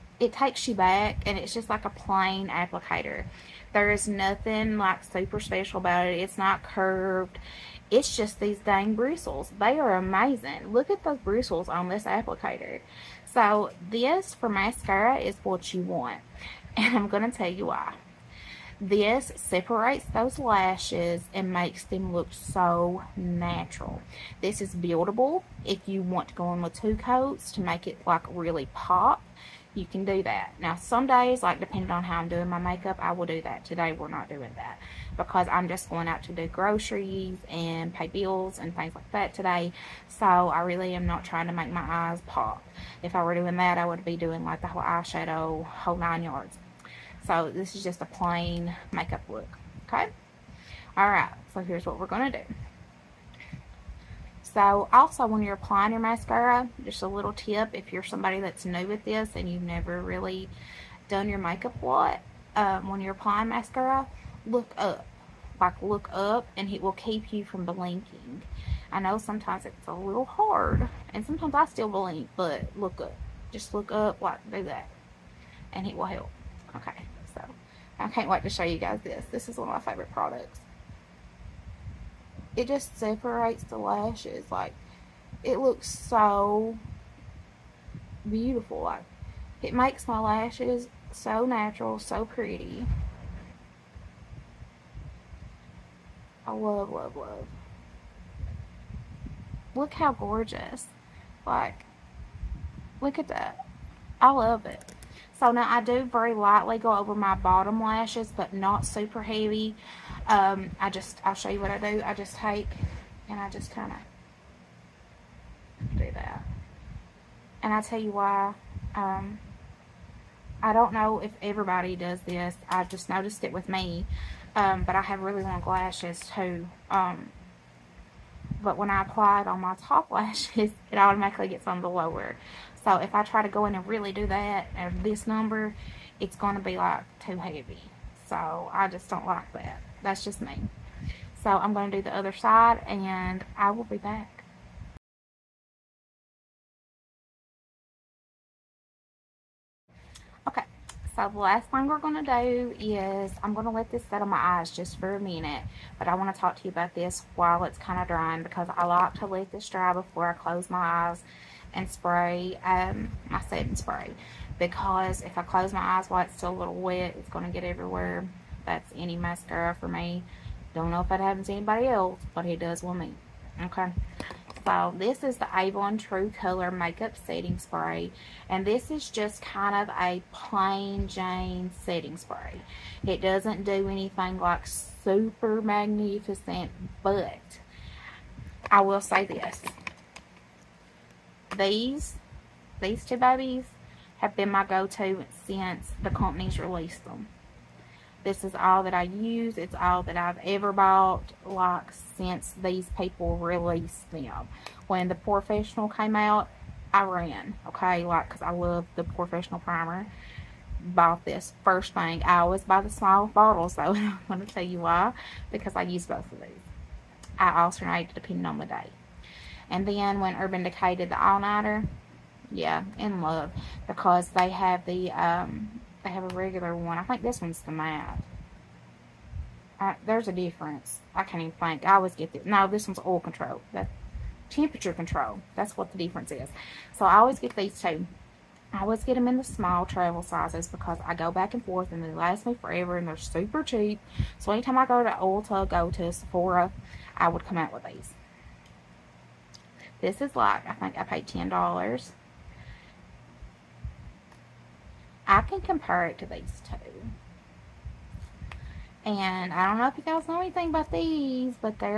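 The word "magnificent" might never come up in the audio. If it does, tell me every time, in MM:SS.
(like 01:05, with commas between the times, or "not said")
03:05.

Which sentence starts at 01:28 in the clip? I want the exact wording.
Like it makes my lashes so natural, so pretty.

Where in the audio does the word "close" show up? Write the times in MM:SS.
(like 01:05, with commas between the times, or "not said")
02:40, 02:45.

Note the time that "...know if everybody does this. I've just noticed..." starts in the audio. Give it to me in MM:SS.
02:00.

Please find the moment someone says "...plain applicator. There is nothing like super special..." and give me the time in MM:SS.
00:01.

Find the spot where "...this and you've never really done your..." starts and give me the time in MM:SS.
00:59.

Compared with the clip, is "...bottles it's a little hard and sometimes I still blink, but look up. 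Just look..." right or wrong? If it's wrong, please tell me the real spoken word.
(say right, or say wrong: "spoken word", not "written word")
wrong: "sometimes", not "bottles".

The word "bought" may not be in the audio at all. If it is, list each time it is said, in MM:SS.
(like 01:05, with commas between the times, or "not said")
03:20, 03:30.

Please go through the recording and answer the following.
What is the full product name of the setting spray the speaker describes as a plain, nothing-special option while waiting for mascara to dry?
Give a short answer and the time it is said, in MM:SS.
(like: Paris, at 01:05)
Avon True Color Makeup Setting Spray, at 02:55.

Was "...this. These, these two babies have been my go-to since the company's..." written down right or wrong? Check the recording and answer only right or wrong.
right.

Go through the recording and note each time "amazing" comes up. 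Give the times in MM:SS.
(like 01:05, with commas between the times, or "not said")
00:09.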